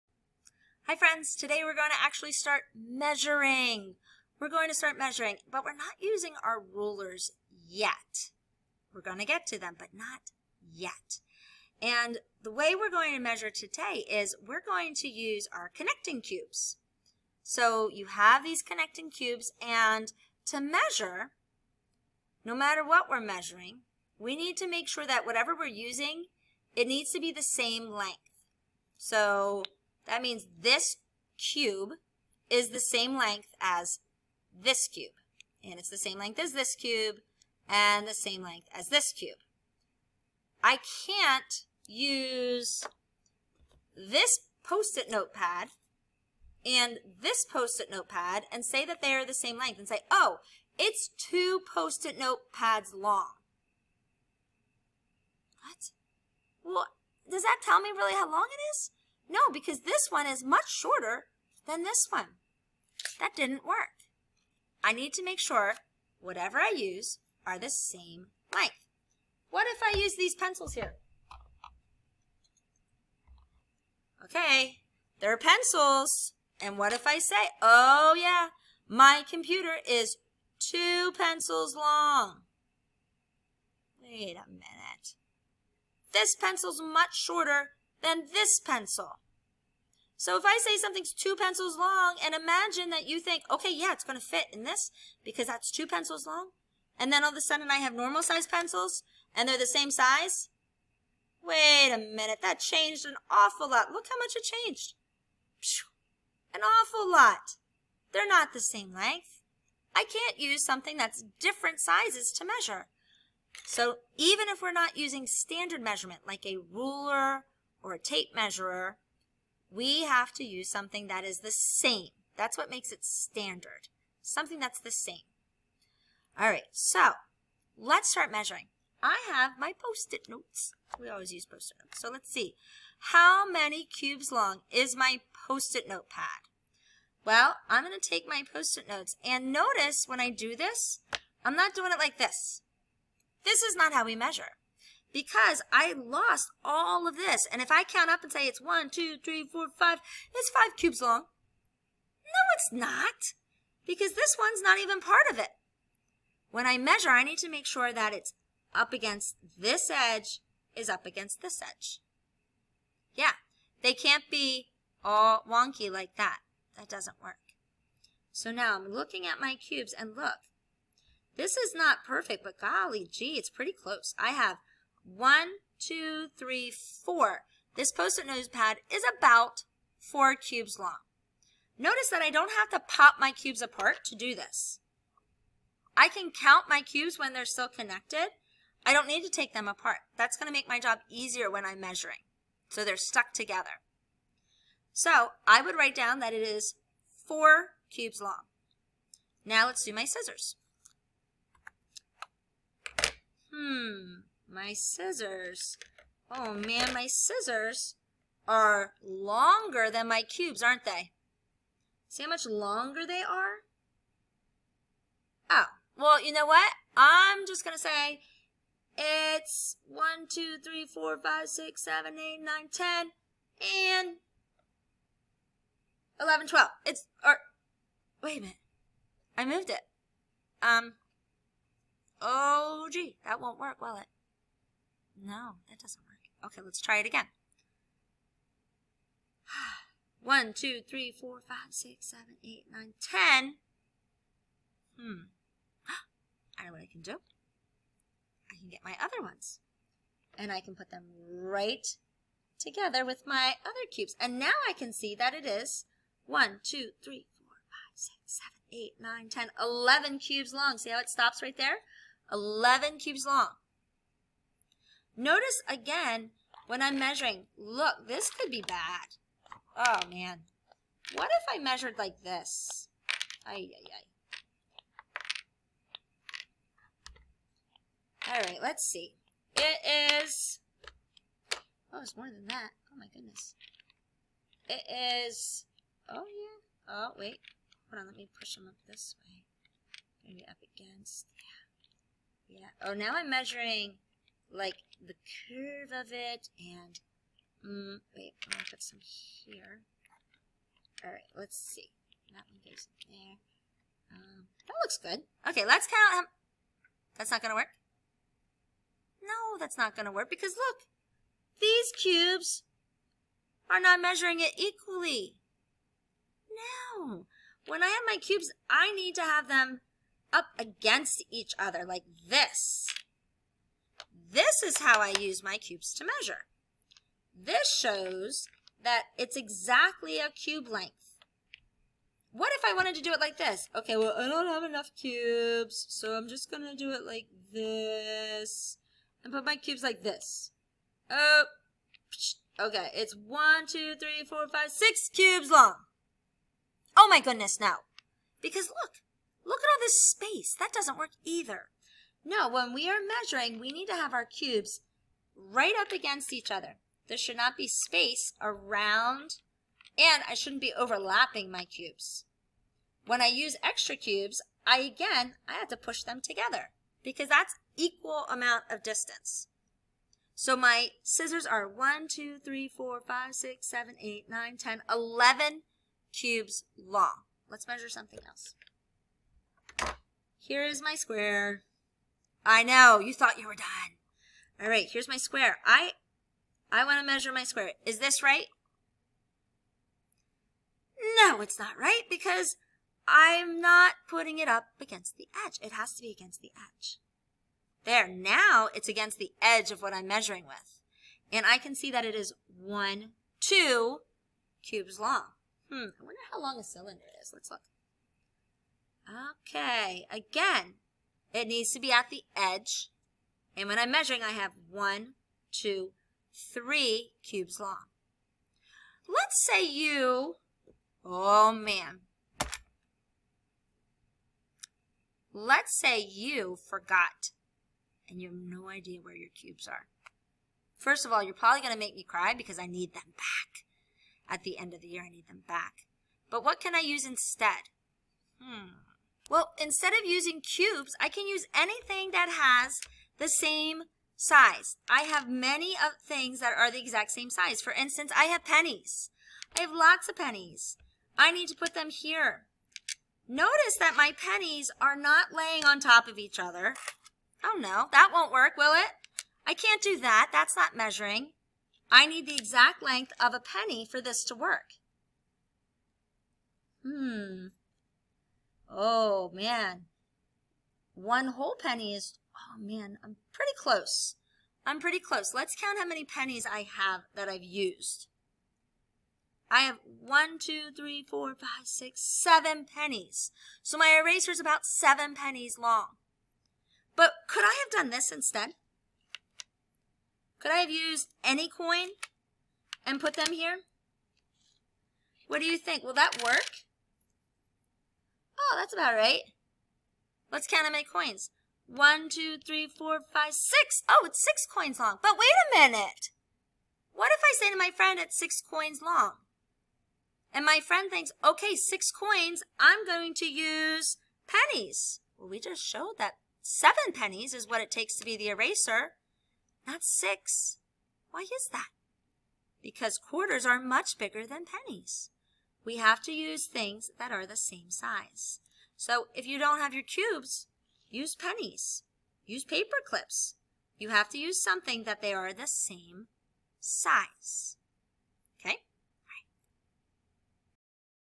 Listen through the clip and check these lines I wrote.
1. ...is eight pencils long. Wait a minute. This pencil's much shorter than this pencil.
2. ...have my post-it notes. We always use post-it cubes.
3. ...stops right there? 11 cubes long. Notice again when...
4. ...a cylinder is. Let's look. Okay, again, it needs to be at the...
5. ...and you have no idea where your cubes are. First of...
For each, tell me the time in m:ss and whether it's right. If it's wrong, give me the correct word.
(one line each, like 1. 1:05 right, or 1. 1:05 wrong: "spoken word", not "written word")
1. 1:19 wrong: "two", not "eight"
2. 2:09 wrong: "notes", not "cubes"
3. 4:21 right
4. 6:46 right
5. 7:08 right.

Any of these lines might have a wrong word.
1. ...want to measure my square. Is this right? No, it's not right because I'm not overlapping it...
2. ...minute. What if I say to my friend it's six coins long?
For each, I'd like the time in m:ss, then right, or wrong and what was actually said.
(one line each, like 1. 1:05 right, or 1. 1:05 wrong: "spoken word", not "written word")
1. 6:26 wrong: "putting", not "overlapping"
2. 8:25 right.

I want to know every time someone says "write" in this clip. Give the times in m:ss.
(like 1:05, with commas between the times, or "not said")
3:15.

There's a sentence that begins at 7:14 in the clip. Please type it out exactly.
At the end of the year, I need them back.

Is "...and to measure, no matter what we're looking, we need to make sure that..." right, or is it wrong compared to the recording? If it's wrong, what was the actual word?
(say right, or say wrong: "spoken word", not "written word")
wrong: "measuring", not "looking".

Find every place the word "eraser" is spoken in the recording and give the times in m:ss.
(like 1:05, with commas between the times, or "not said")
8:04, 8:38.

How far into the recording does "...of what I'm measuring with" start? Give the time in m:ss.
6:39.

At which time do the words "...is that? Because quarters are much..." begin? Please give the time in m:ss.
8:41.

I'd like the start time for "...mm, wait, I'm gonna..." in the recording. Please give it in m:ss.
4:57.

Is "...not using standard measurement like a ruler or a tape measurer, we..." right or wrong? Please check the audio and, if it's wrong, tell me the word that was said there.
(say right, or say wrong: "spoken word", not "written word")
right.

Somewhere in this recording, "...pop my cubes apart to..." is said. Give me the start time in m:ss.
3:02.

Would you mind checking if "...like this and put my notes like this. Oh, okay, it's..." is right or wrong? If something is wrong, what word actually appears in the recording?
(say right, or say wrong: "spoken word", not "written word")
wrong: "cubes", not "notes".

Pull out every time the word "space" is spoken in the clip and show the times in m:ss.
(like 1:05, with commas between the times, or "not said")
5:50, 5:57.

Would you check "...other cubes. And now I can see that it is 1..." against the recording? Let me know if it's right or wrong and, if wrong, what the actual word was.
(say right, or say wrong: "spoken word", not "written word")
right.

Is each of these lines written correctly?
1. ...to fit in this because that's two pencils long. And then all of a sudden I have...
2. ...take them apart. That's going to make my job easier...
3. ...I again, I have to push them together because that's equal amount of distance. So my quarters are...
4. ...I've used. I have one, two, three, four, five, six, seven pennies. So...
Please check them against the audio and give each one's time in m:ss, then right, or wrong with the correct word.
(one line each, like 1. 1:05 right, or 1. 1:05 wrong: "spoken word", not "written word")
1. 1:34 right
2. 3:09 right
3. 6:04 wrong: "scissors", not "quarters"
4. 7:57 right.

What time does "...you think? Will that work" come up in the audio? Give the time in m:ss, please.
8:15.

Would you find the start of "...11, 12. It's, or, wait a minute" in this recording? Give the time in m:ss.
3:46.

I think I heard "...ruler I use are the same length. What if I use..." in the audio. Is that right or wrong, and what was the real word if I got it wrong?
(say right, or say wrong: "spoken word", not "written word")
wrong: "whatever", not "ruler".